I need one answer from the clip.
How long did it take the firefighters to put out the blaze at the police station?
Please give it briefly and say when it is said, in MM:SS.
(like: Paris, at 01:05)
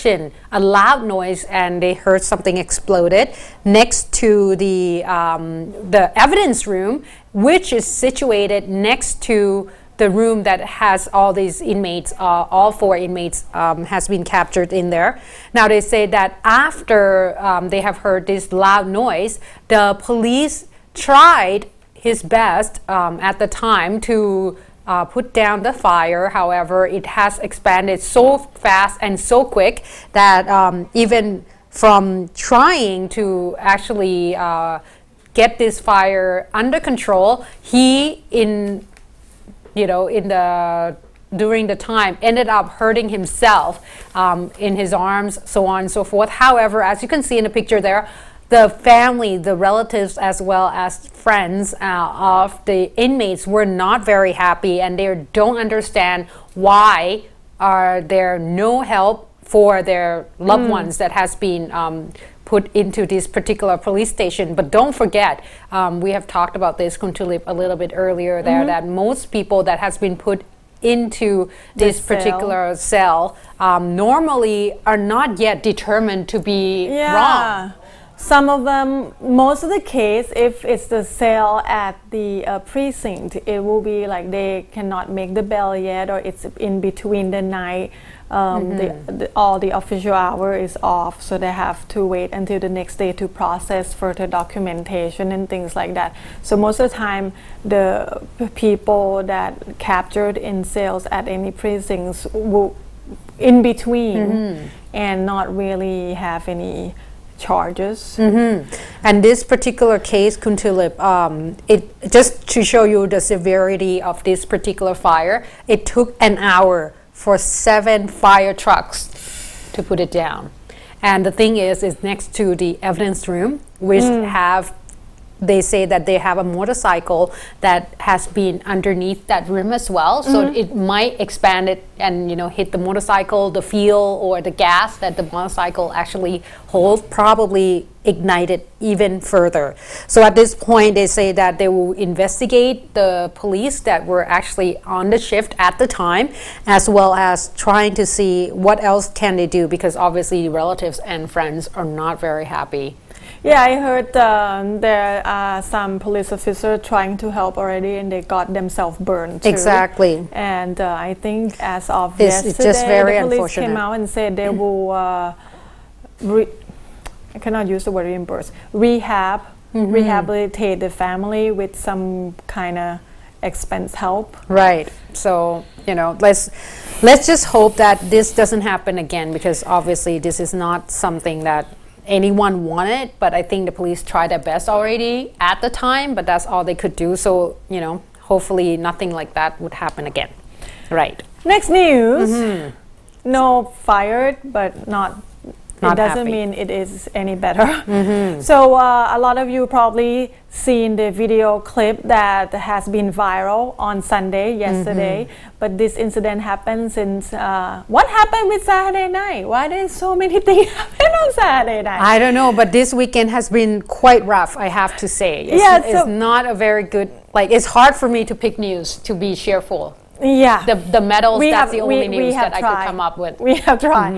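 an hour, at 01:56.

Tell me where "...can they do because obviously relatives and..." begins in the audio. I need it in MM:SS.
02:29.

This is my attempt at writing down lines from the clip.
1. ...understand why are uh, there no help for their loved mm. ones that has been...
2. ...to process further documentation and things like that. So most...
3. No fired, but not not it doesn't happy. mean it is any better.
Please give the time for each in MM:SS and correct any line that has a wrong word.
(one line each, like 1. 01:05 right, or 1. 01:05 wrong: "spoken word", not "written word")
1. 00:55 right
2. 01:33 right
3. 03:13 right.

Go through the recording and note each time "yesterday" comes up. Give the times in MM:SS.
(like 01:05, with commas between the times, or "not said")
02:42, 03:24.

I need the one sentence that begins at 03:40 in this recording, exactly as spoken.
The, the medals, we that's have, the only we, news we that tried.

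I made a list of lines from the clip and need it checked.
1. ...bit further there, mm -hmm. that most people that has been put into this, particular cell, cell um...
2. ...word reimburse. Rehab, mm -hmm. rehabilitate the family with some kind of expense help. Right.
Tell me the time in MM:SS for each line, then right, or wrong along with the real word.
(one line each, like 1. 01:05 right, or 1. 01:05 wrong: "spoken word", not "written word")
1. 01:07 wrong: "earlier", not "further"
2. 02:47 right.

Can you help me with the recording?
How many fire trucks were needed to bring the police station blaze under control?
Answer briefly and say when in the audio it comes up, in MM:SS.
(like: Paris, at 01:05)
7, at 01:57.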